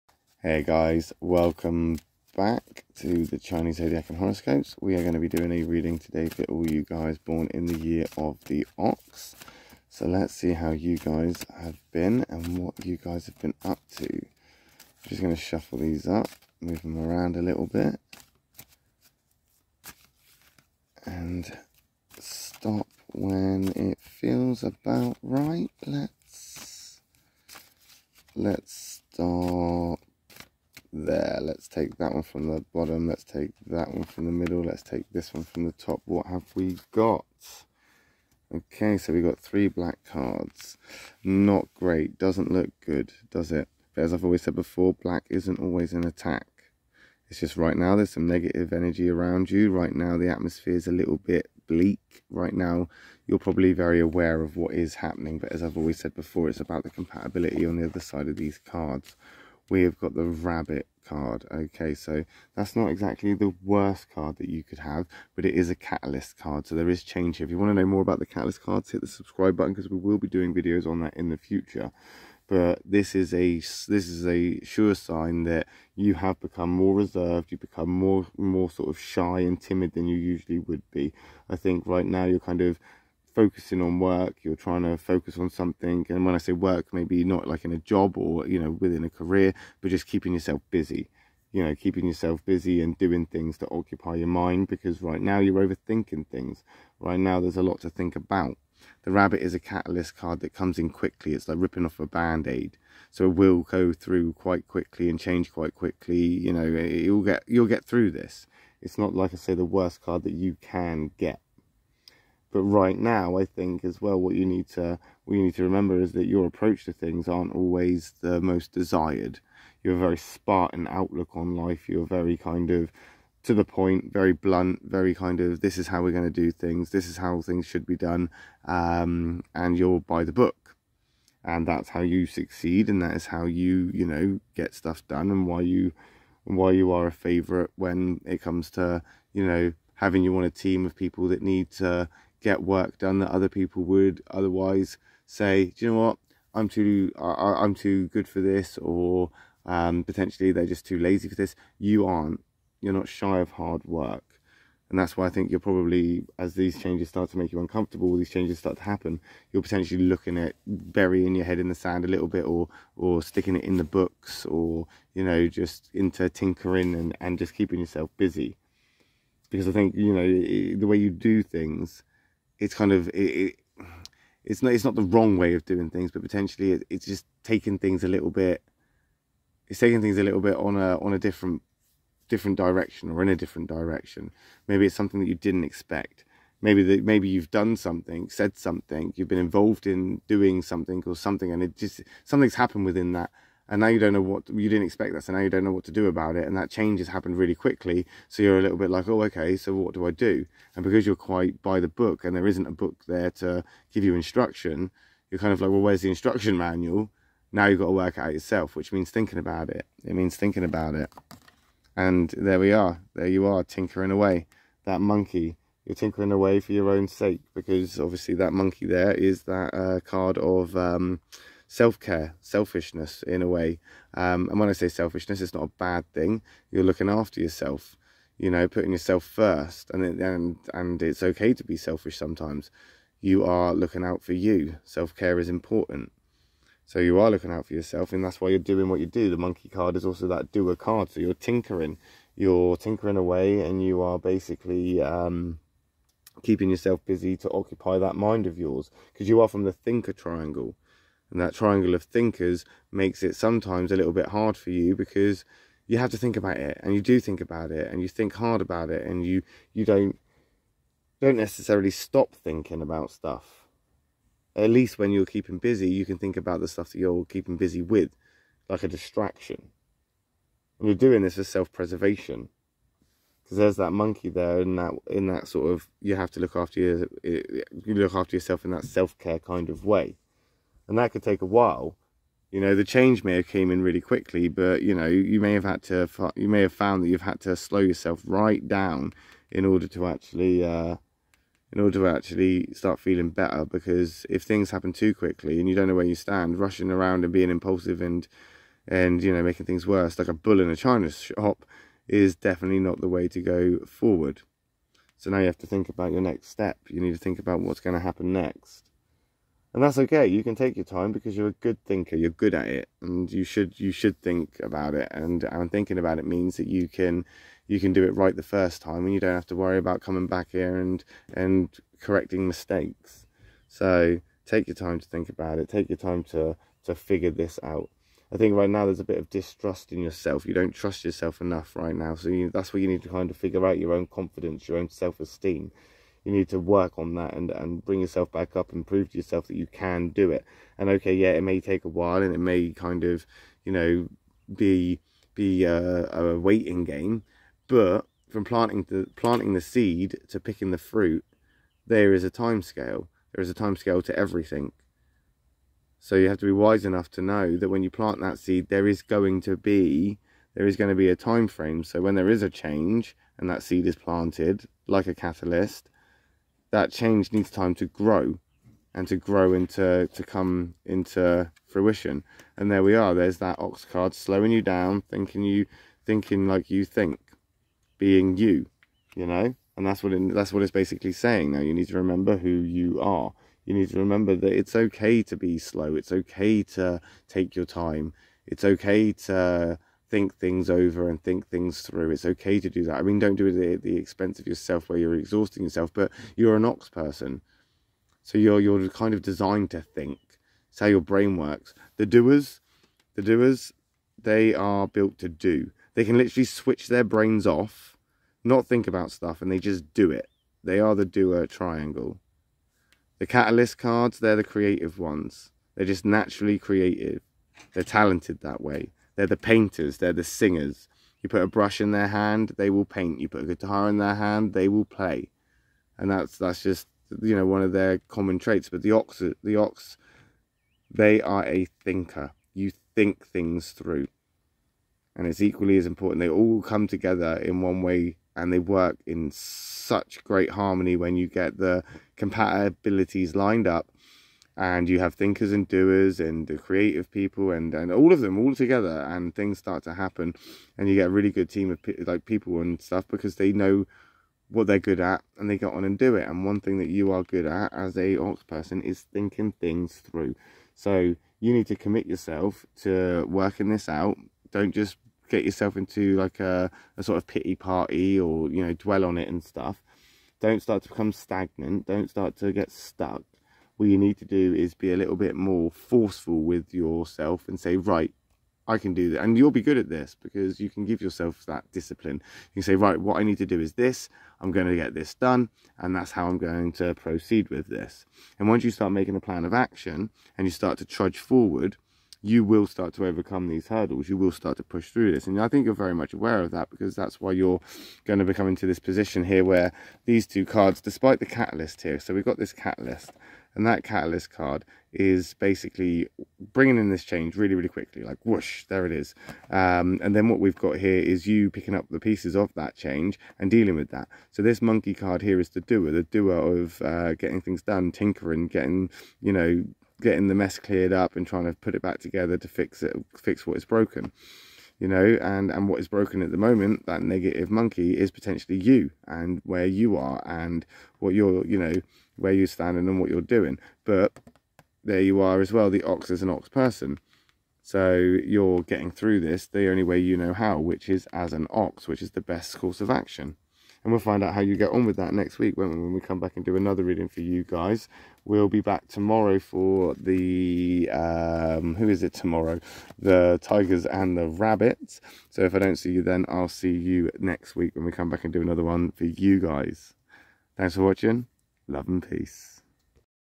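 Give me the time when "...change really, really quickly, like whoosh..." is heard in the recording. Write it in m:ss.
8:27.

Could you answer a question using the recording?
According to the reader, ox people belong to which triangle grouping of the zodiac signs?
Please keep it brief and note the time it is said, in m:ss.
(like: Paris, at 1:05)
thinker triangle, at 4:09.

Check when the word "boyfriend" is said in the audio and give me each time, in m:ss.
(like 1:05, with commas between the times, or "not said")
not said.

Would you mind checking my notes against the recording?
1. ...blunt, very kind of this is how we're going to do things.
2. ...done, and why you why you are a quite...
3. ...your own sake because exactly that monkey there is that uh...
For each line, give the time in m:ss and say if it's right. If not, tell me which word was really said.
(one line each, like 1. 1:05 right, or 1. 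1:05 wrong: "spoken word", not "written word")
1. 2:04 right
2. 2:15 wrong: "favourite", not "quite"
3. 3:36 wrong: "obviously", not "exactly".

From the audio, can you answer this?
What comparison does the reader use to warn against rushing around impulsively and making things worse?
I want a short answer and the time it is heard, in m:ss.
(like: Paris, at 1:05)
a bull in a china shop, at 5:00.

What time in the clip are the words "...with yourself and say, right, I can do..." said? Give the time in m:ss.
7:56.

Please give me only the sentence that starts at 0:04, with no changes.
We are going to be doing a reading today for all you guys born in the year of the ox.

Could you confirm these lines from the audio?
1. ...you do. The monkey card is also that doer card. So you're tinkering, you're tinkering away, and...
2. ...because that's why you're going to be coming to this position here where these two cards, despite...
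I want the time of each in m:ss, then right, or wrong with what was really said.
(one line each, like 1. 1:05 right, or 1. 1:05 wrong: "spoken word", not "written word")
1. 3:58 right
2. 8:16 right.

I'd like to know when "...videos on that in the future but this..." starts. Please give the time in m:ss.
1:10.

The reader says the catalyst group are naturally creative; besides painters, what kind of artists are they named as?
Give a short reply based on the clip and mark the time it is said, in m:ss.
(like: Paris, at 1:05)
singers, at 7:00.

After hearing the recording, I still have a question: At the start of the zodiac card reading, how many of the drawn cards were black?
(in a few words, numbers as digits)
3.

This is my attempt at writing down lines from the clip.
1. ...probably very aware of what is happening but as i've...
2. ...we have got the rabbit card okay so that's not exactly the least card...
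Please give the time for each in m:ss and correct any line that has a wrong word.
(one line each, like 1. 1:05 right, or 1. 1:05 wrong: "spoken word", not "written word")
1. 0:53 right
2. 0:59 wrong: "worst", not "least".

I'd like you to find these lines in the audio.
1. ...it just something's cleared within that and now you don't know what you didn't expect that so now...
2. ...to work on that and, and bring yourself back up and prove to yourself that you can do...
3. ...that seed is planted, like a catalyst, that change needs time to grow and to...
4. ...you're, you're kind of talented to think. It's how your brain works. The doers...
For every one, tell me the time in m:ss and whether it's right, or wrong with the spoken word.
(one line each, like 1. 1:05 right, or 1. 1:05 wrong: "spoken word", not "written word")
1. 3:11 wrong: "happened", not "cleared"
2. 5:36 right
3. 6:03 right
4. 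6:38 wrong: "designed", not "talented".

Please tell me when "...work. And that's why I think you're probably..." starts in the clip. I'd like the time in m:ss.
2:33.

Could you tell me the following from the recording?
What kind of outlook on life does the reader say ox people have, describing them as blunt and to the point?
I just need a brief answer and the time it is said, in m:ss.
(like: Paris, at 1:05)
Spartan, at 2:00.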